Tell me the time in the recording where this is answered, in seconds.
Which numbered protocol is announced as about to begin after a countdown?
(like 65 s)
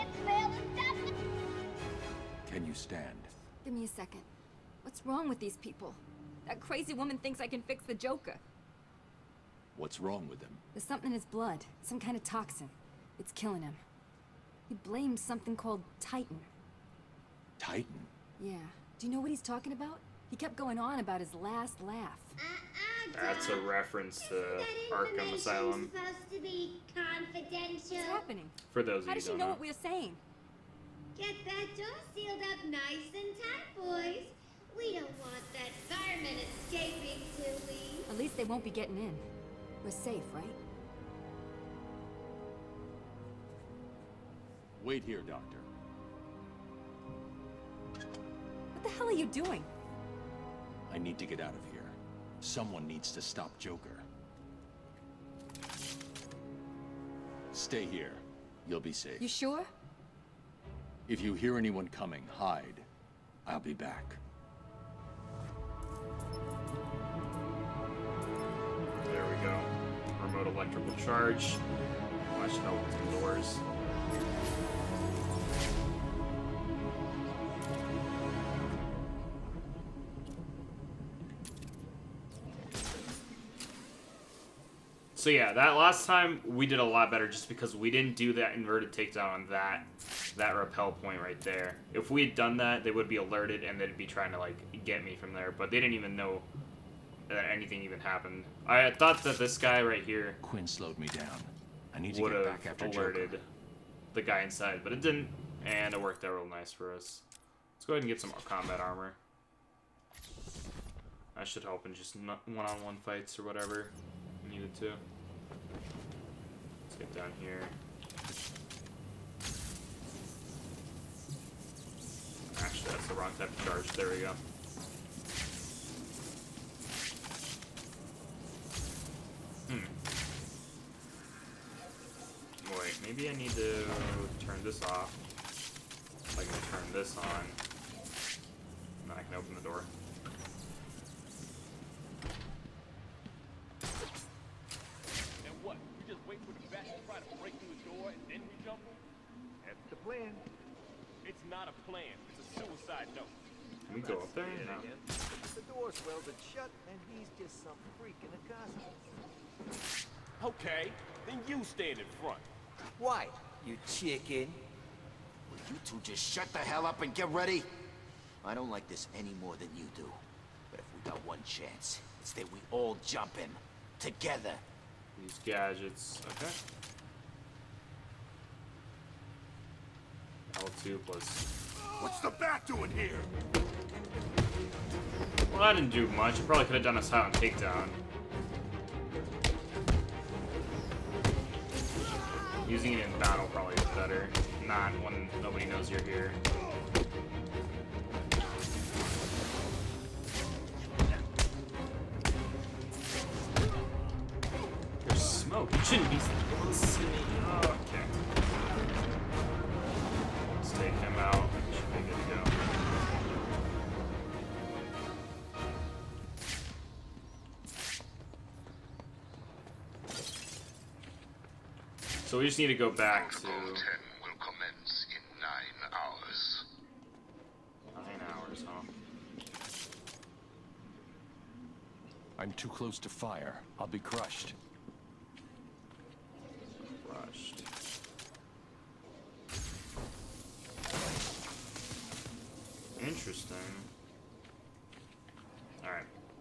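223 s.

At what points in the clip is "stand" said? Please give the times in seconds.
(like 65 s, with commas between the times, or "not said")
2 s, 161 s.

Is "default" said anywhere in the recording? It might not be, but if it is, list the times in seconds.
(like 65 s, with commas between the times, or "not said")
not said.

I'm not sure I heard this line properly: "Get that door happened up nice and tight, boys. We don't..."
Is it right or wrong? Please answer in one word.
wrong.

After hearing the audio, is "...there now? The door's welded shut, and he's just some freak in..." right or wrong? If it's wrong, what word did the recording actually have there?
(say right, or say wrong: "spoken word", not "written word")
right.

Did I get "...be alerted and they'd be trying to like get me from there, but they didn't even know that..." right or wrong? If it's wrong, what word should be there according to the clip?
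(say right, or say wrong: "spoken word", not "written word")
right.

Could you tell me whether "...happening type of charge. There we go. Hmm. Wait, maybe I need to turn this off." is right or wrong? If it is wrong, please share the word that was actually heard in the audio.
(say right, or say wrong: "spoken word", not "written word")
wrong: "wrong", not "happening".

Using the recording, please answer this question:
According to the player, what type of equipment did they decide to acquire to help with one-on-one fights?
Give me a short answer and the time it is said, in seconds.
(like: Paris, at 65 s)
Combat armor, at 108 s.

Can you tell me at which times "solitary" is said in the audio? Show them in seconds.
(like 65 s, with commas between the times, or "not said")
not said.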